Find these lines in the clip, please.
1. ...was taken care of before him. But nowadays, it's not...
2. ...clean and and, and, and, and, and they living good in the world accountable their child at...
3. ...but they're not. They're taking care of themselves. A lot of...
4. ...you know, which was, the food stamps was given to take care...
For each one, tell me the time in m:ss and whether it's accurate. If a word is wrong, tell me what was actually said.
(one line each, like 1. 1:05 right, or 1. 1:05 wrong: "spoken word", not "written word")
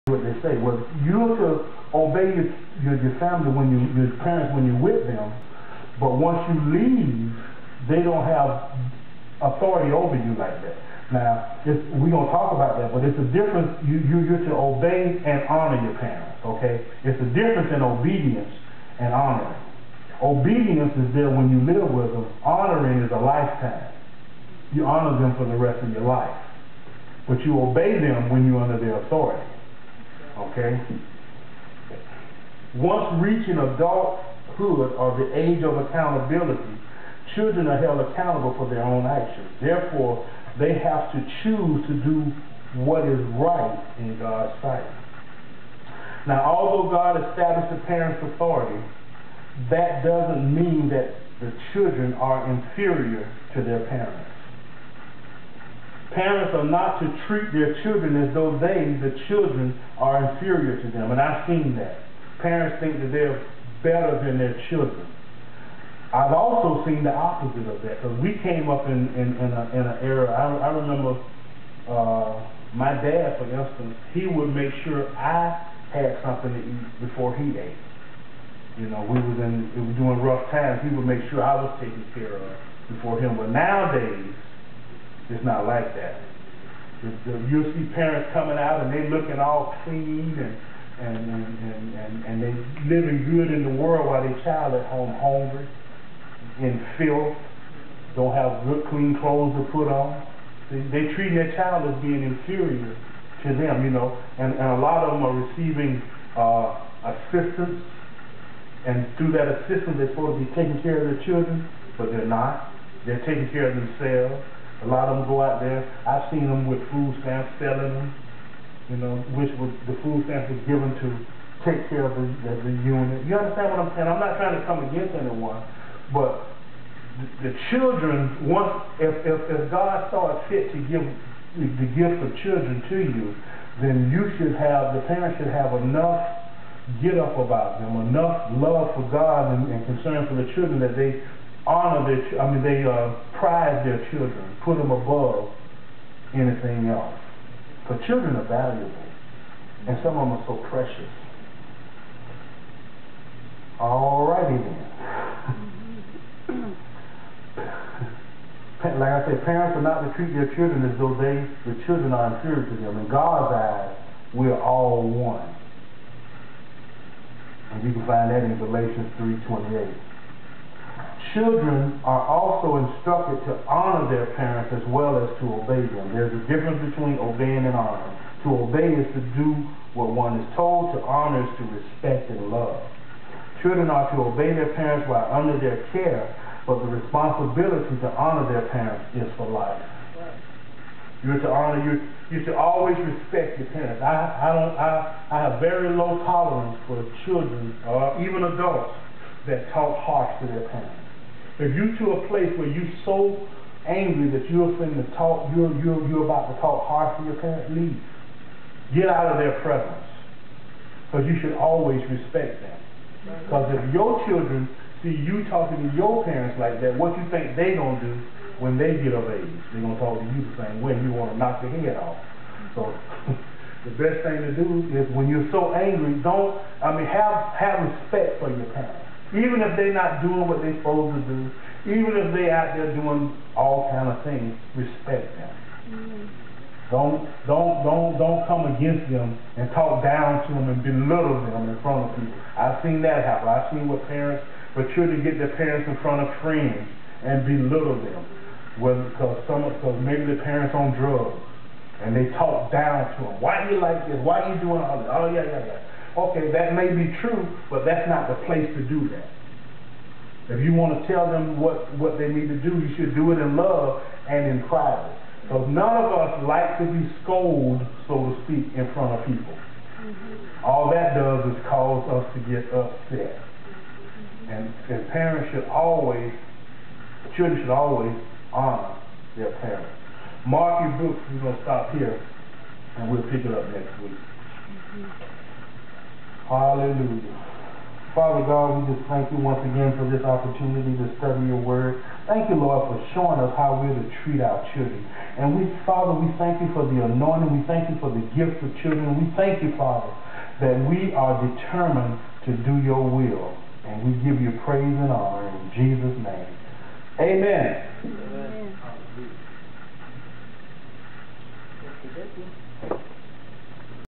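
1. 1:21 right
2. 1:29 wrong: "while", not "accountable"
3. 1:51 right
4. 1:58 right.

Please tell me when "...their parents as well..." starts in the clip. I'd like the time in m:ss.
2:54.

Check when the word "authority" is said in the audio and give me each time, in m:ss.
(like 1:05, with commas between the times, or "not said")
0:09, 0:29, 0:48.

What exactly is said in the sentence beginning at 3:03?
Children are to obey their parents while under their care, but the responsibility to honor their parents is for life.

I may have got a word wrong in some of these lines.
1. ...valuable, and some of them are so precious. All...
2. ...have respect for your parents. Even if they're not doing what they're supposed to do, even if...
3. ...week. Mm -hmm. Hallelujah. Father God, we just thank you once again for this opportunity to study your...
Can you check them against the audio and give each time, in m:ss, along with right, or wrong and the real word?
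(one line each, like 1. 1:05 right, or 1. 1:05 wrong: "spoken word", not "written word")
1. 2:28 right
2. 3:47 right
3. 4:44 right.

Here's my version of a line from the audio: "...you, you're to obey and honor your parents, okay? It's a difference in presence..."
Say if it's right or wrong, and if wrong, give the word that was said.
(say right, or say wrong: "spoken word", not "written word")
wrong: "obedience", not "presence".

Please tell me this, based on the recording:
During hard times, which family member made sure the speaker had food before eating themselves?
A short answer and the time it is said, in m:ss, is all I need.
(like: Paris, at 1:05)
Dad, at 1:12.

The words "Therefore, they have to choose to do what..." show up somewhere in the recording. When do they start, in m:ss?
0:39.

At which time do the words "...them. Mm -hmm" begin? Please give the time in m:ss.
3:55.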